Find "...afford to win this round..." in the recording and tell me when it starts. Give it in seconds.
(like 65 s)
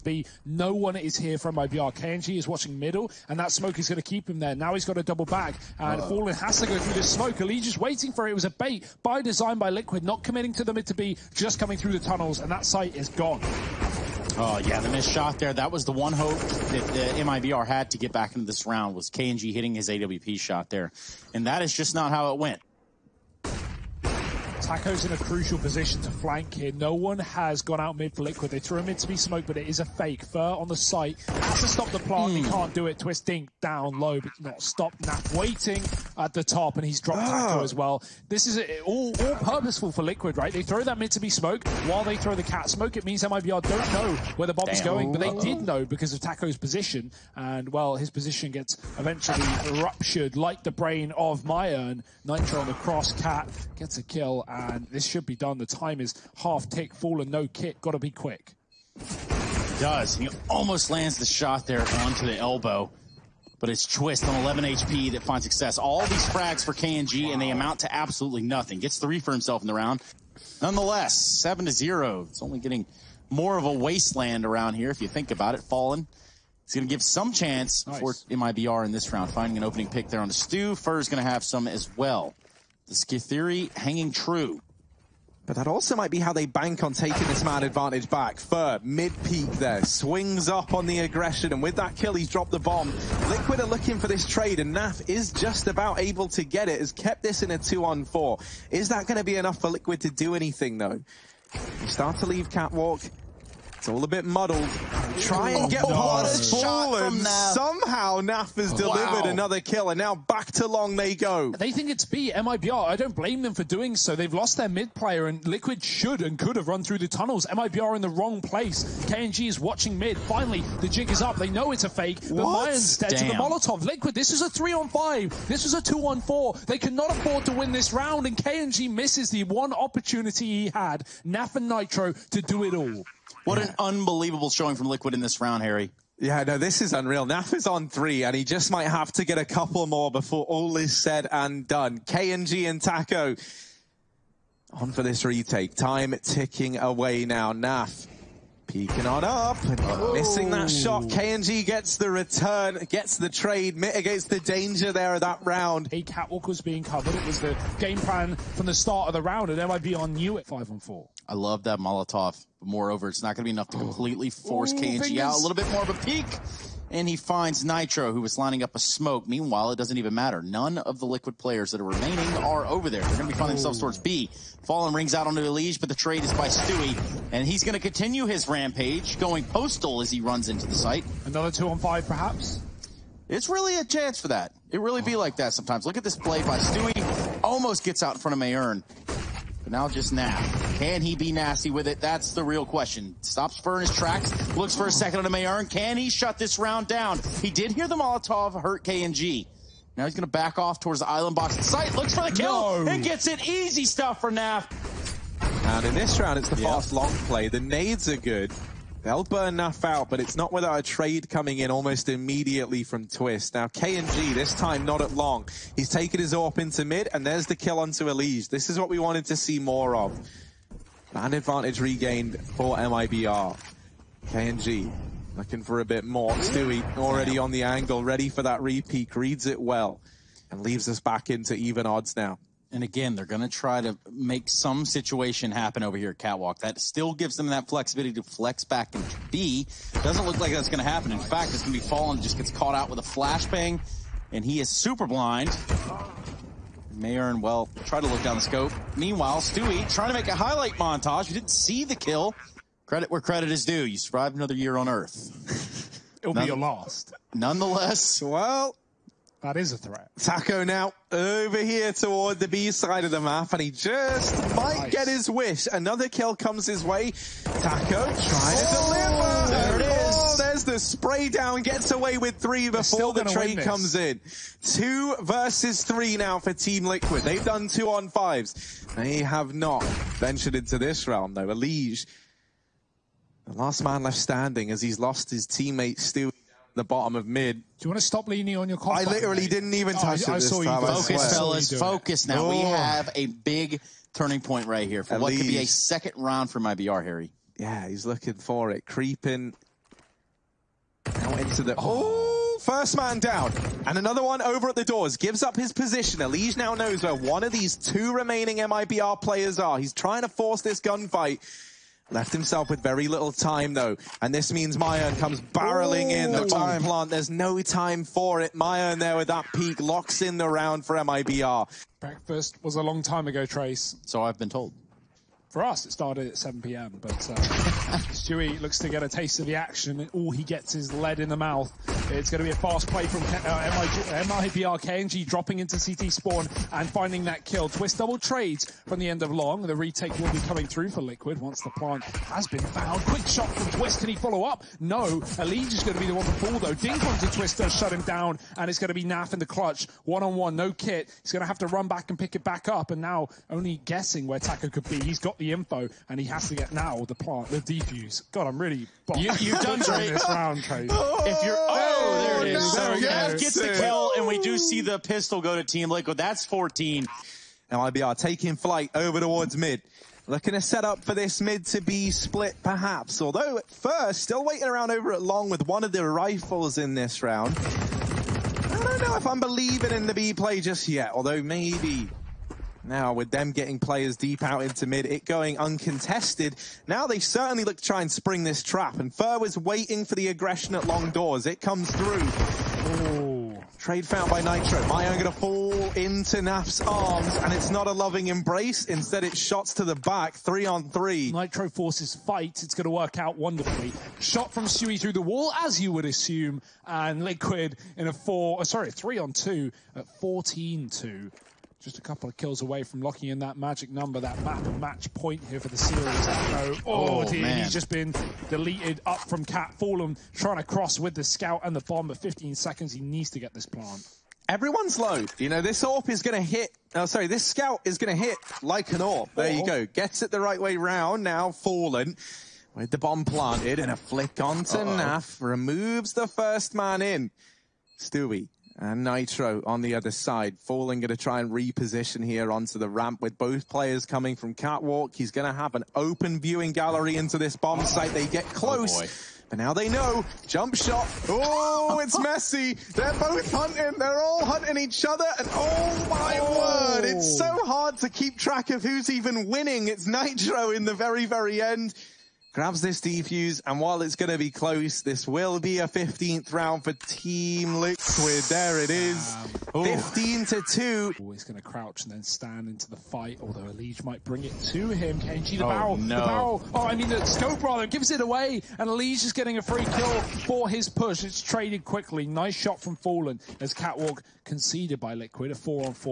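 127 s.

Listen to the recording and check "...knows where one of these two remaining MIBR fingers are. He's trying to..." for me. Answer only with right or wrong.
wrong.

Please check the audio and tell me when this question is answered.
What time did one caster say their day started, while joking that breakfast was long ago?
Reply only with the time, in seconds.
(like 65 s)
326 s.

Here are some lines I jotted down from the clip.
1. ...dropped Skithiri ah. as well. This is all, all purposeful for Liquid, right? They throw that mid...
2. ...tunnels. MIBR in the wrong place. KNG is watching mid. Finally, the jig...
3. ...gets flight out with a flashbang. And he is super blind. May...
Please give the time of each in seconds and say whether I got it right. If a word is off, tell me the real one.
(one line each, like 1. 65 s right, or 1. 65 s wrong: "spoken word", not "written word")
1. 36 s wrong: "Taco", not "Skithiri"
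2. 117 s right
3. 242 s wrong: "caught", not "flight".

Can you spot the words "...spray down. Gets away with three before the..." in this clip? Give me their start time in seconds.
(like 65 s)
270 s.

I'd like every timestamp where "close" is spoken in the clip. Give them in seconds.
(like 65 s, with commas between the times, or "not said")
448 s, 464 s.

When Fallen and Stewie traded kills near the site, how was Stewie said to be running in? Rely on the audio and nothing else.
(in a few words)
postal.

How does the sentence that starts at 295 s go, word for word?
could be a second round for IBR, Harry.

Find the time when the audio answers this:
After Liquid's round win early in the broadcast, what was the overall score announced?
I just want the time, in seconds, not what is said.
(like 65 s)
71 s.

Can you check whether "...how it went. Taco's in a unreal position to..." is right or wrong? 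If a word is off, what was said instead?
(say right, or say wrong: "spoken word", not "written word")
wrong: "crucial", not "unreal".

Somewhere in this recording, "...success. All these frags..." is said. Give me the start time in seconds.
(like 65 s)
65 s.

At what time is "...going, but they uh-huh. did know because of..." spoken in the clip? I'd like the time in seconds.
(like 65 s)
44 s.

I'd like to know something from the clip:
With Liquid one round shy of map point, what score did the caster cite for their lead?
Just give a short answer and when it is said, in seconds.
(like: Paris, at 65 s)
14-2, at 410 s.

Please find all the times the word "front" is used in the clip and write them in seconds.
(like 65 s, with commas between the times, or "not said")
188 s.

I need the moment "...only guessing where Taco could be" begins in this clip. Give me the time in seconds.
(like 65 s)
353 s.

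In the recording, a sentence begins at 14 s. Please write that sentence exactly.
Oh, yeah, the missed shot there.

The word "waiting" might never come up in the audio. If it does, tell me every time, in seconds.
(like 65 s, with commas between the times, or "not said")
7 s, 35 s, 374 s, 389 s.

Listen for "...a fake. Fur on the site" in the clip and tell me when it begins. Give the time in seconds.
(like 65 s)
29 s.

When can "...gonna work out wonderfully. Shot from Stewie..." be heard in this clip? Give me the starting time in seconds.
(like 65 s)
402 s.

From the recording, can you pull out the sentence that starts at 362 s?
There so yes, gets the kill, and we do see the pistol go to Team Liquid.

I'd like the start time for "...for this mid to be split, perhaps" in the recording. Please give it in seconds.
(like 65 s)
371 s.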